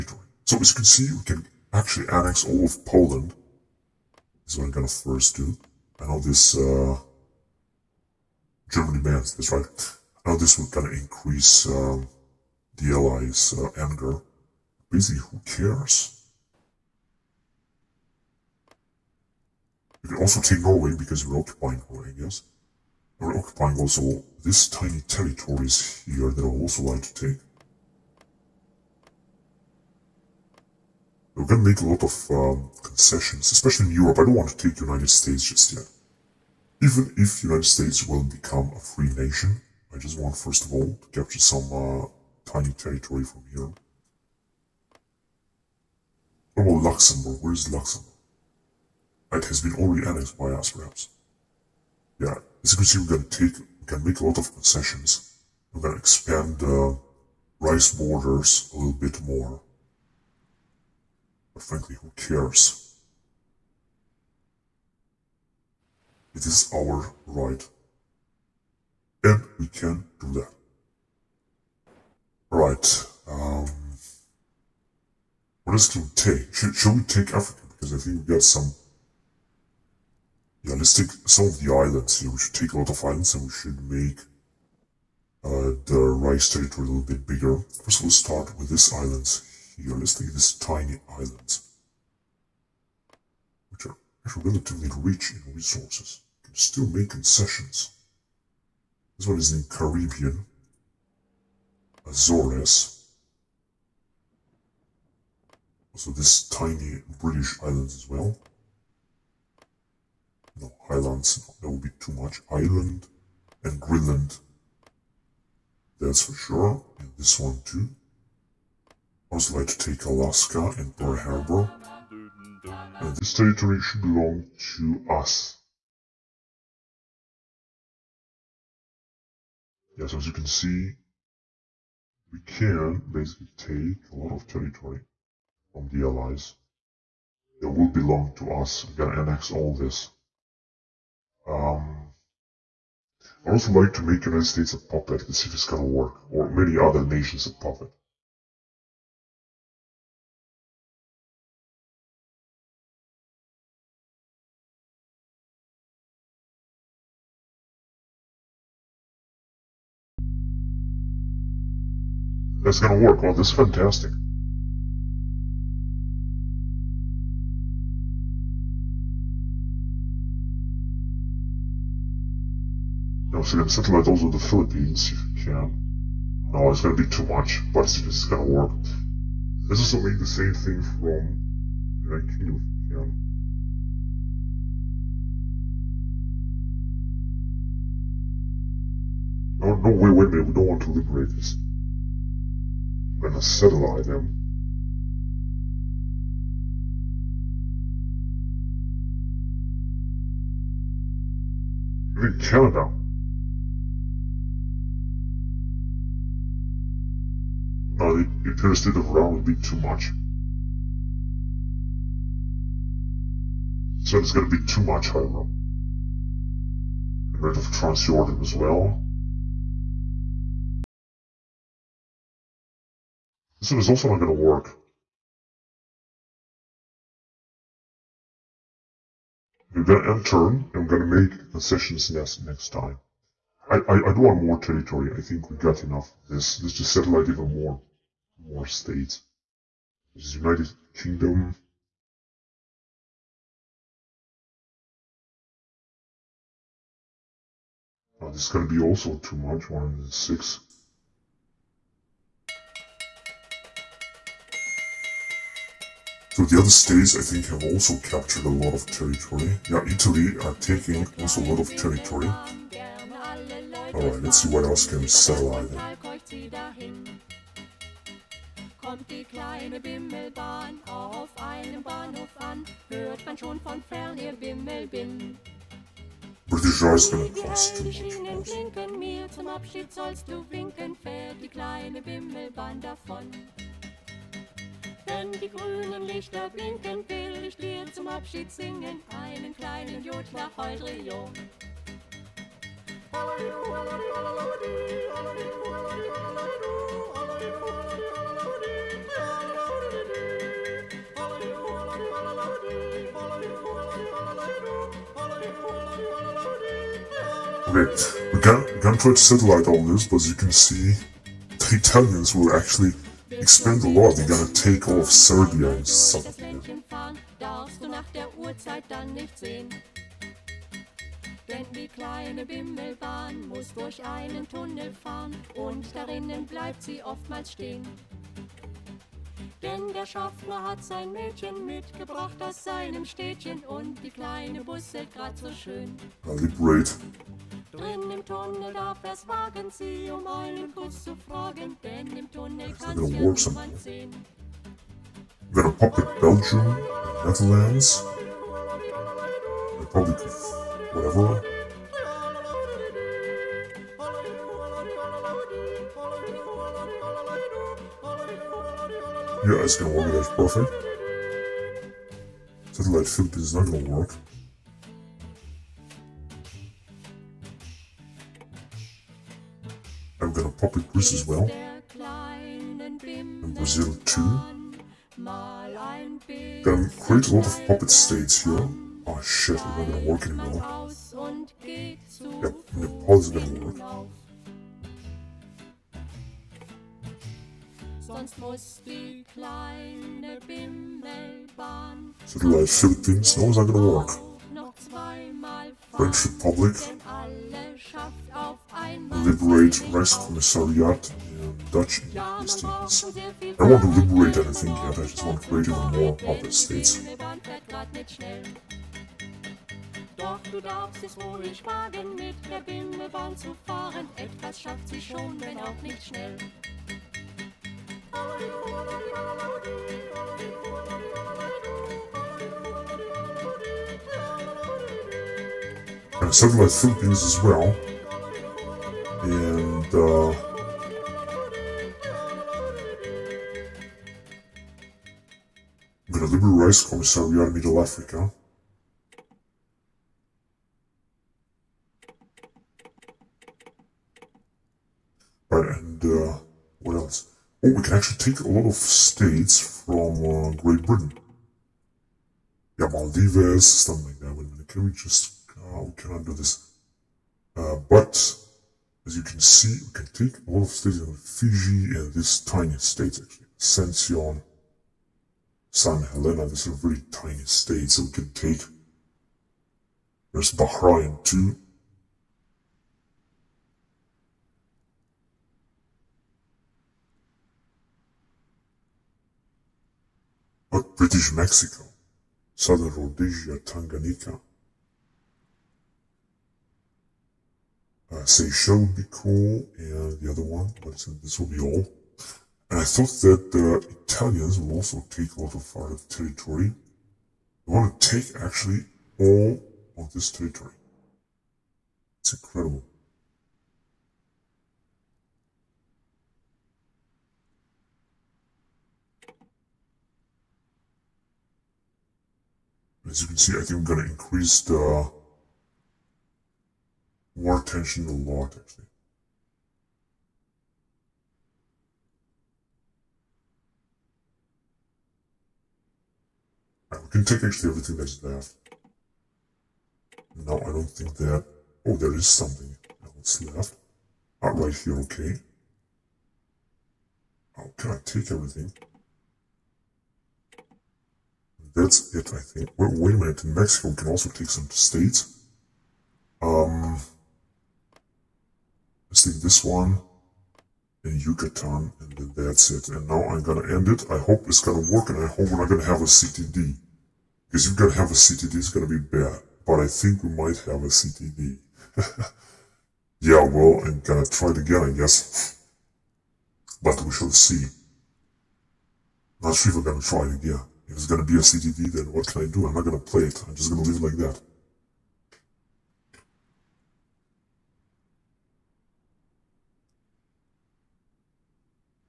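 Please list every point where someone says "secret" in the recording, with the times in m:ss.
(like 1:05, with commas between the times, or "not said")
not said.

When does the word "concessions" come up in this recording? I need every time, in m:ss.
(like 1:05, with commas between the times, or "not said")
0:32, 0:54, 1:37, 3:51.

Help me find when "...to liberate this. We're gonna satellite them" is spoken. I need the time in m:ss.
3:10.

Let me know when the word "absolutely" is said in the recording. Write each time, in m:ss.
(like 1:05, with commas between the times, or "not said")
not said.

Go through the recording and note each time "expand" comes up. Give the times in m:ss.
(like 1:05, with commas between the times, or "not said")
0:55, 5:13.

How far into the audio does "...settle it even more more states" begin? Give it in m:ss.
3:56.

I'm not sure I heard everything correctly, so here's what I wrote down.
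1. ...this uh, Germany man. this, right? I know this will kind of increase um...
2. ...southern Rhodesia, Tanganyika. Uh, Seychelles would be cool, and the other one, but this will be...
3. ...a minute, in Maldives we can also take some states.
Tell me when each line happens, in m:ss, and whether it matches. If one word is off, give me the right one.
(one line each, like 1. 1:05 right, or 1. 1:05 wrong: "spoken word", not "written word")
1. 0:06 right
2. 8:02 right
3. 9:03 wrong: "Mexico", not "Maldives".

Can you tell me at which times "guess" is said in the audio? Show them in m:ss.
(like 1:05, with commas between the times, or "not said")
0:22, 9:24.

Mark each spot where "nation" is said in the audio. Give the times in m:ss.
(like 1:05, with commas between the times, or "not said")
0:39, 2:27.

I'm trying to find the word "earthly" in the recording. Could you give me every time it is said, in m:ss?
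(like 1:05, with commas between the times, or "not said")
not said.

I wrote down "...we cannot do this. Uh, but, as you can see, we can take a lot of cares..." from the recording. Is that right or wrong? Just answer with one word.
wrong.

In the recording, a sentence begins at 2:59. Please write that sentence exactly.
Let's also make the same thing from United Kingdom if you can.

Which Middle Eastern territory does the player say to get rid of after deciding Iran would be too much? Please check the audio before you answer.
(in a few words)
Transjordan.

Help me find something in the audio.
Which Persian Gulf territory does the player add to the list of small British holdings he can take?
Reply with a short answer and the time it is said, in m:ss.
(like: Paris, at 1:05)
Bahrain, at 7:50.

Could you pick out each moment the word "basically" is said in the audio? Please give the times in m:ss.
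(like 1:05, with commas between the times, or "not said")
0:14, 2:13.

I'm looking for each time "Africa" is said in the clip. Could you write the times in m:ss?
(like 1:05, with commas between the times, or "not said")
1:17, 7:17.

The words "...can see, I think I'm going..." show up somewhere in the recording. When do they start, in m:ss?
8:33.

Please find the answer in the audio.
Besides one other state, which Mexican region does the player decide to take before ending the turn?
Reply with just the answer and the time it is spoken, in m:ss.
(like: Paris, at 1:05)
Yucatan, at 9:11.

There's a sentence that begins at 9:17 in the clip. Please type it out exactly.
Because if you're gonna have a CTD, it's gonna be bad.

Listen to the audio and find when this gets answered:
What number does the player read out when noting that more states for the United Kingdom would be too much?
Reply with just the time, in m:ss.
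4:09.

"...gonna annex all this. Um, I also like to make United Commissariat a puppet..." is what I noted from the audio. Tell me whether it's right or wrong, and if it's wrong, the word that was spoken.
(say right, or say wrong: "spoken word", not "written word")
wrong: "States", not "Commissariat".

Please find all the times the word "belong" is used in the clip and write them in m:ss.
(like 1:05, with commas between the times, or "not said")
2:04, 2:17.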